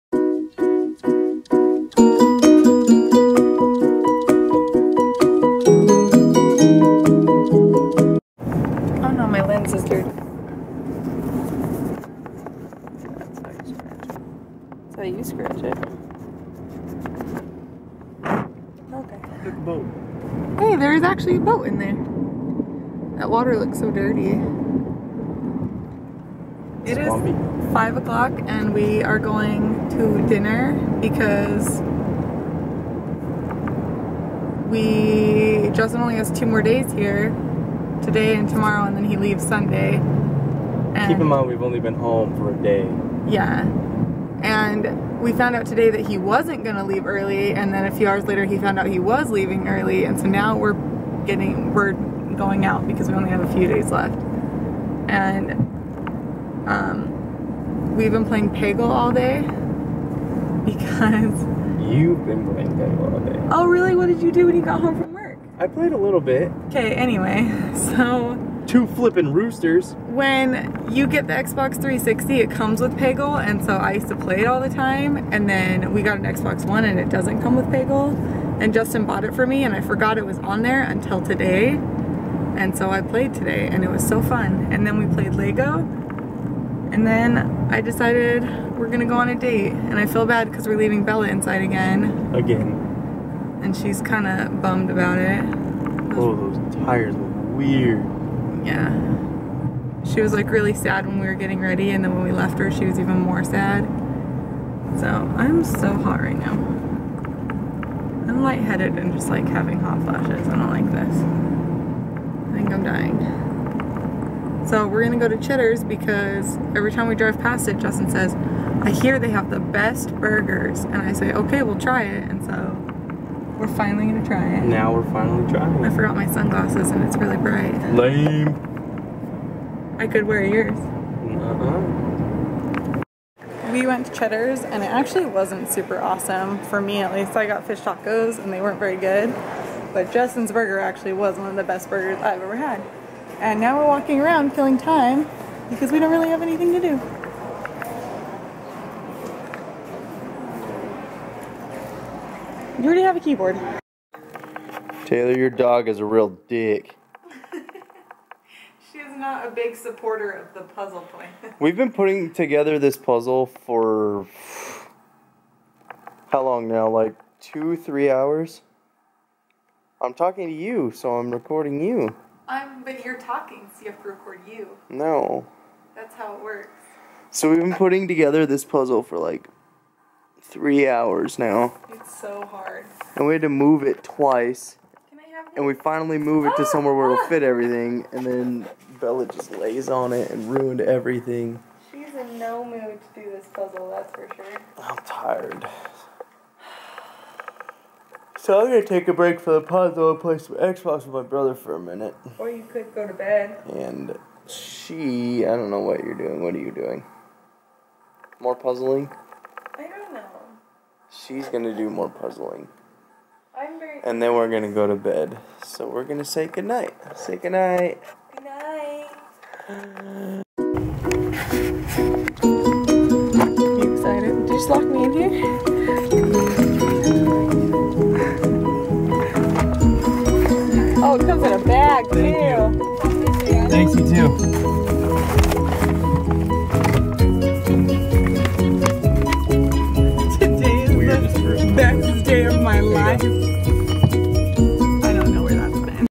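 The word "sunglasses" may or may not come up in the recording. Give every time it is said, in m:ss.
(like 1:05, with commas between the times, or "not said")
2:06.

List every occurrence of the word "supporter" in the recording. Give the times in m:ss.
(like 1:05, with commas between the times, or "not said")
2:39.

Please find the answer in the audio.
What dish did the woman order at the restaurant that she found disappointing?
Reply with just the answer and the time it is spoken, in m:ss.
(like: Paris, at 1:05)
fish tacos, at 2:17.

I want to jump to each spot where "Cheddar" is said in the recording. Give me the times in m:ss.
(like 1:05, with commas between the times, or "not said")
1:55, 2:14.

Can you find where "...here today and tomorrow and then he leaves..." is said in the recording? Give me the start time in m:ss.
0:36.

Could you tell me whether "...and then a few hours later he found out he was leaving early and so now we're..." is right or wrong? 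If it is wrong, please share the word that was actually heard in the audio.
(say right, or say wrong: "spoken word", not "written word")
right.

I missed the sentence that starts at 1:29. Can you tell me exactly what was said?
And I feel bad because we're leaving Bella inside again.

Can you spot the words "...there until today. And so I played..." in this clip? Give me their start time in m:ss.
1:20.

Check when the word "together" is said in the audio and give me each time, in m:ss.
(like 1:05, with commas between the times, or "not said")
2:42, 2:58.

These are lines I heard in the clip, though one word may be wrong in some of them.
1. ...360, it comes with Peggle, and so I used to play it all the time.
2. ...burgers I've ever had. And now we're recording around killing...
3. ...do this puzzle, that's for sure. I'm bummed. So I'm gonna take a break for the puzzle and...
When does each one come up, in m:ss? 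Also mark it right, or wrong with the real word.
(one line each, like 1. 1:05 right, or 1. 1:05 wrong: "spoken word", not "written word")
1. 1:11 right
2. 2:21 wrong: "walking", not "recording"
3. 3:13 wrong: "tired", not "bummed".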